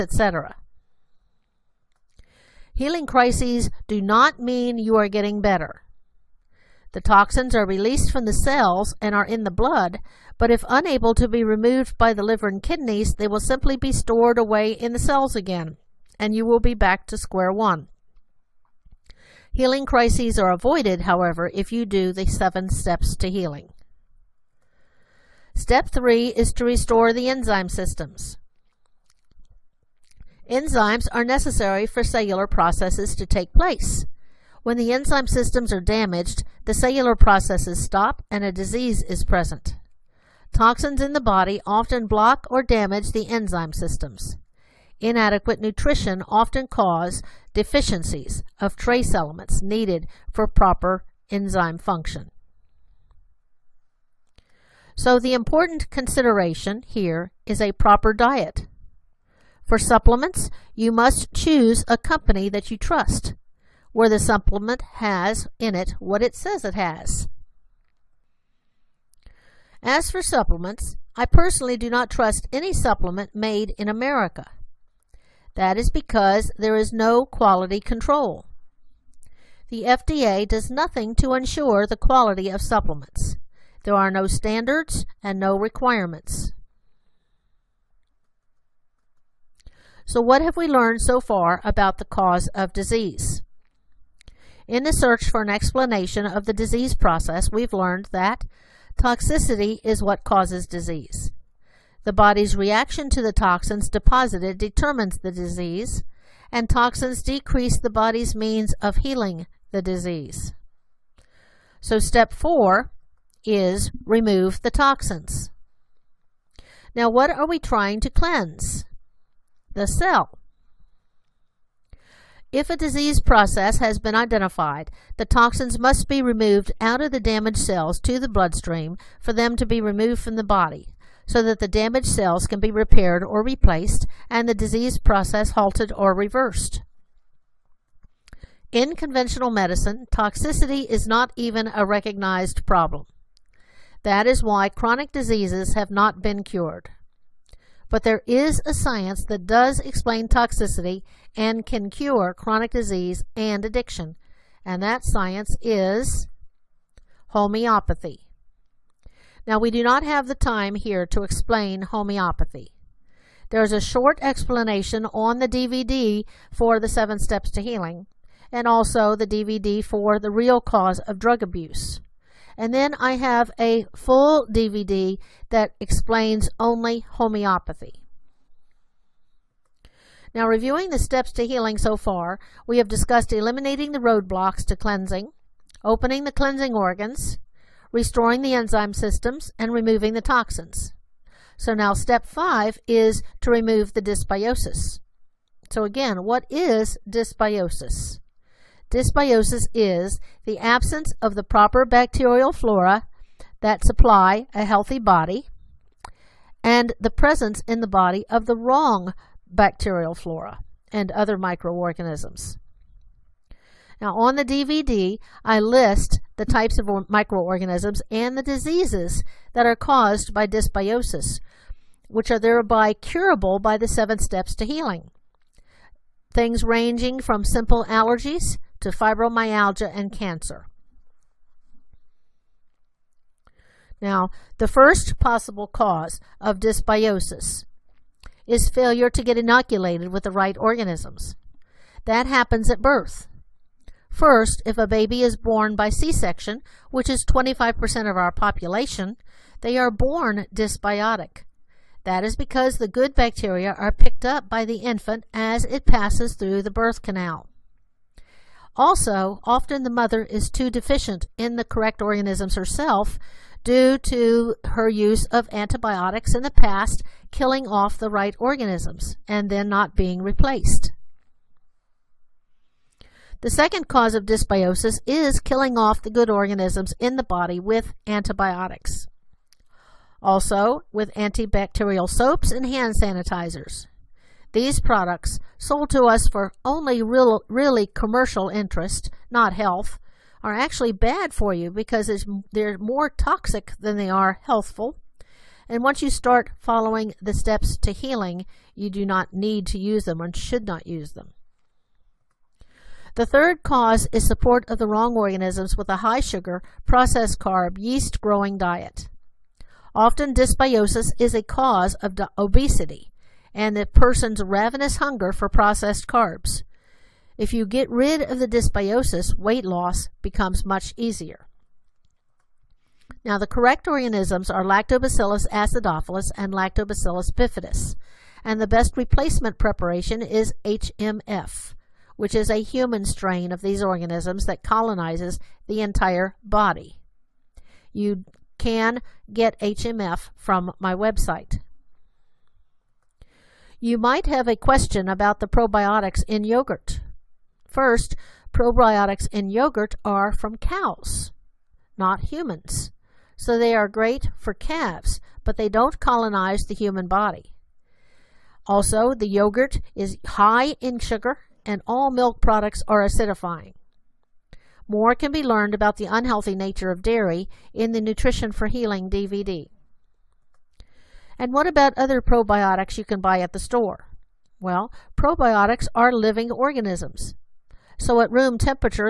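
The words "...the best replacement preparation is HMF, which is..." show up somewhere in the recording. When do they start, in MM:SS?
05:28.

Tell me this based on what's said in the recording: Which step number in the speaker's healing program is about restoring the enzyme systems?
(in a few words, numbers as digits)
Three.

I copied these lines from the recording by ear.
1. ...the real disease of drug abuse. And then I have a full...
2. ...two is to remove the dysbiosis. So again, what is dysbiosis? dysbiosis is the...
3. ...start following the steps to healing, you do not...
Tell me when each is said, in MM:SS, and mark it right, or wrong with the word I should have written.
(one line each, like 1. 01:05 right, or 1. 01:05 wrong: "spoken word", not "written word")
1. 02:50 wrong: "cause", not "disease"
2. 03:12 wrong: "five", not "two"
3. 04:56 right.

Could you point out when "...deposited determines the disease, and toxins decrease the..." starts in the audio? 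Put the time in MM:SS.
01:43.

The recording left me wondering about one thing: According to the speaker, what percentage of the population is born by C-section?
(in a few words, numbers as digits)
25%.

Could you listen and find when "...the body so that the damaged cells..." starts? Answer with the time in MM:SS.
02:10.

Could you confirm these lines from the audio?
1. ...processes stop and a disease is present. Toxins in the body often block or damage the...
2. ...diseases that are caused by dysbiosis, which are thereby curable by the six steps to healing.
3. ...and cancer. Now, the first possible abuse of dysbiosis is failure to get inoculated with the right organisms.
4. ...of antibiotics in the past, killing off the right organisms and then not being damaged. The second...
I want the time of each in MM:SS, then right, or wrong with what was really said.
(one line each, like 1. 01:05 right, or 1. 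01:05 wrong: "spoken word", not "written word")
1. 00:37 right
2. 03:38 wrong: "seven", not "six"
3. 03:49 wrong: "cause", not "abuse"
4. 04:25 wrong: "replaced", not "damaged".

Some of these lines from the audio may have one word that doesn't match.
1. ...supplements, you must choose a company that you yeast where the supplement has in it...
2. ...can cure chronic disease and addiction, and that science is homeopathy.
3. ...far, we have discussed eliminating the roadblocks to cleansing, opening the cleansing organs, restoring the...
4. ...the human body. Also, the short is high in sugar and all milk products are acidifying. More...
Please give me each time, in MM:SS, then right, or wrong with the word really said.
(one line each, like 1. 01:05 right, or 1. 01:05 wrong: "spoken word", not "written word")
1. 00:59 wrong: "trust", not "yeast"
2. 02:31 right
3. 03:01 right
4. 05:56 wrong: "yogurt", not "short".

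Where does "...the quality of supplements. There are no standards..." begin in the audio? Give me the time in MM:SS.
01:21.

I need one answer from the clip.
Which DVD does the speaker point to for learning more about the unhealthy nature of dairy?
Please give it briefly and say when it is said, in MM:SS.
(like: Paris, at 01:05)
Nutrition for Healing, at 06:08.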